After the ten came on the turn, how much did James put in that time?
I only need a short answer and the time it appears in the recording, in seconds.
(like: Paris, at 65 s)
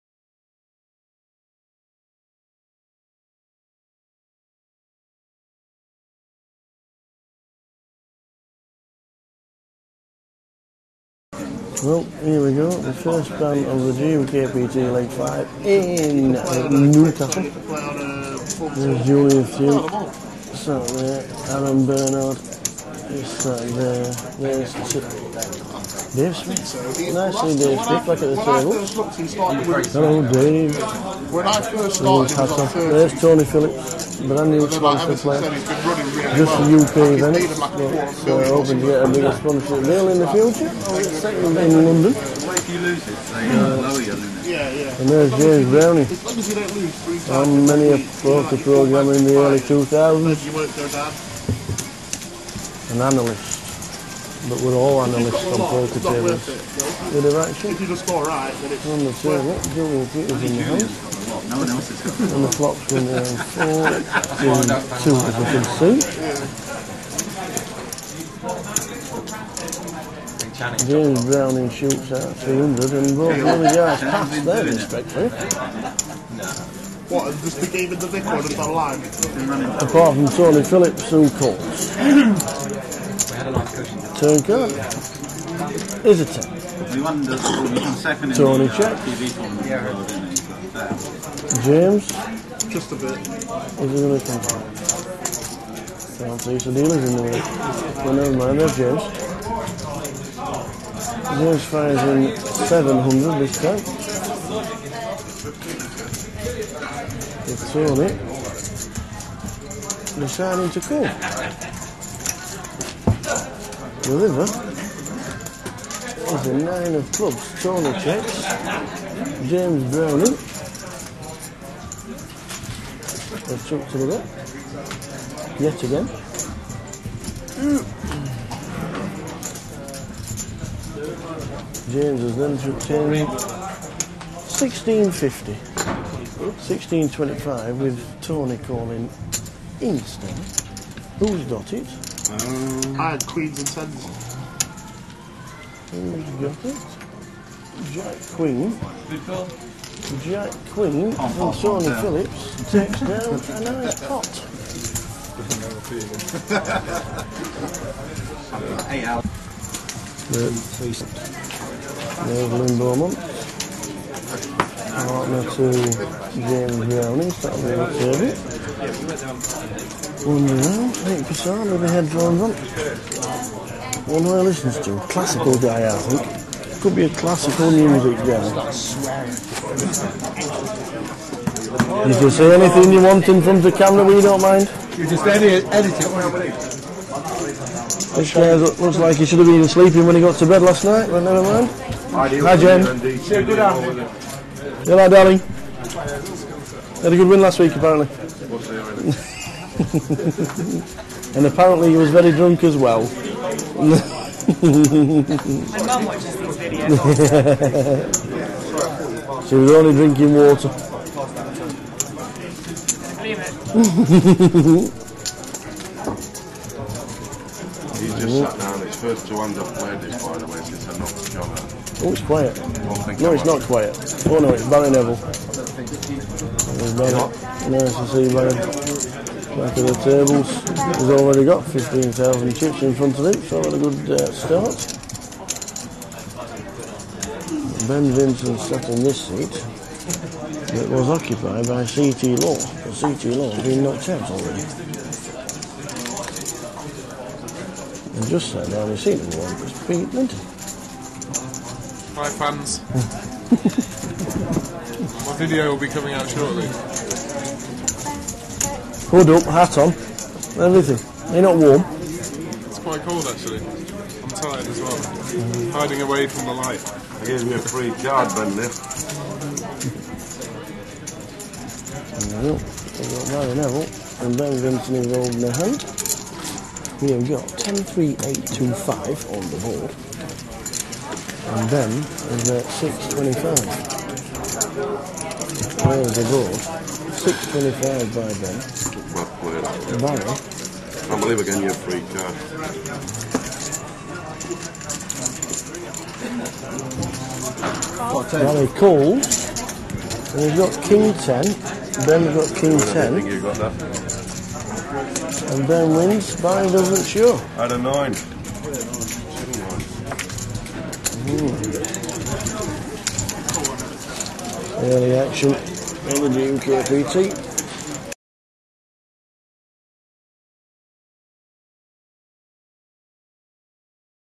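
700, at 102 s.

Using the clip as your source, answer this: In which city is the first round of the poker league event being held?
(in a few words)
Newcastle.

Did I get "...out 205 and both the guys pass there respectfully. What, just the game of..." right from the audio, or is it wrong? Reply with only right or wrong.
wrong.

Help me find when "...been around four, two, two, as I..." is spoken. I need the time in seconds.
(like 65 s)
62 s.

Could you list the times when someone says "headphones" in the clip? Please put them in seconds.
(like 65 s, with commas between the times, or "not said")
171 s.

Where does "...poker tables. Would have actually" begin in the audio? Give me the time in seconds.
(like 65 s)
55 s.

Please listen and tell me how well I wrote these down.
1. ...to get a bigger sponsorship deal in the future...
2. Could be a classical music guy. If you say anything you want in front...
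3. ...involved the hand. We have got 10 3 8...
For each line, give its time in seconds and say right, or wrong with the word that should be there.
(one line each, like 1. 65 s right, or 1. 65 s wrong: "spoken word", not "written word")
1. 38 s right
2. 176 s right
3. 274 s right.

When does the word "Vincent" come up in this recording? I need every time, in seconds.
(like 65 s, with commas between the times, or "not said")
238 s, 274 s.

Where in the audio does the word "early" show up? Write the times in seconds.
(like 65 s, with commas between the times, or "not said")
49 s, 314 s.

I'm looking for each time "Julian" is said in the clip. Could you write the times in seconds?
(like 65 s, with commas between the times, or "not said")
19 s, 59 s.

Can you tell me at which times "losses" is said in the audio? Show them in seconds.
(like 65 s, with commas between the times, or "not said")
not said.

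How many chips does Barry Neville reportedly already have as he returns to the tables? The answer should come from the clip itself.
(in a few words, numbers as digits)
15,000.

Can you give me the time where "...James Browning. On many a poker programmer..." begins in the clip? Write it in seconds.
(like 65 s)
45 s.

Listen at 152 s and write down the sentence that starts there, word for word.
Phillips takes down a nice pot.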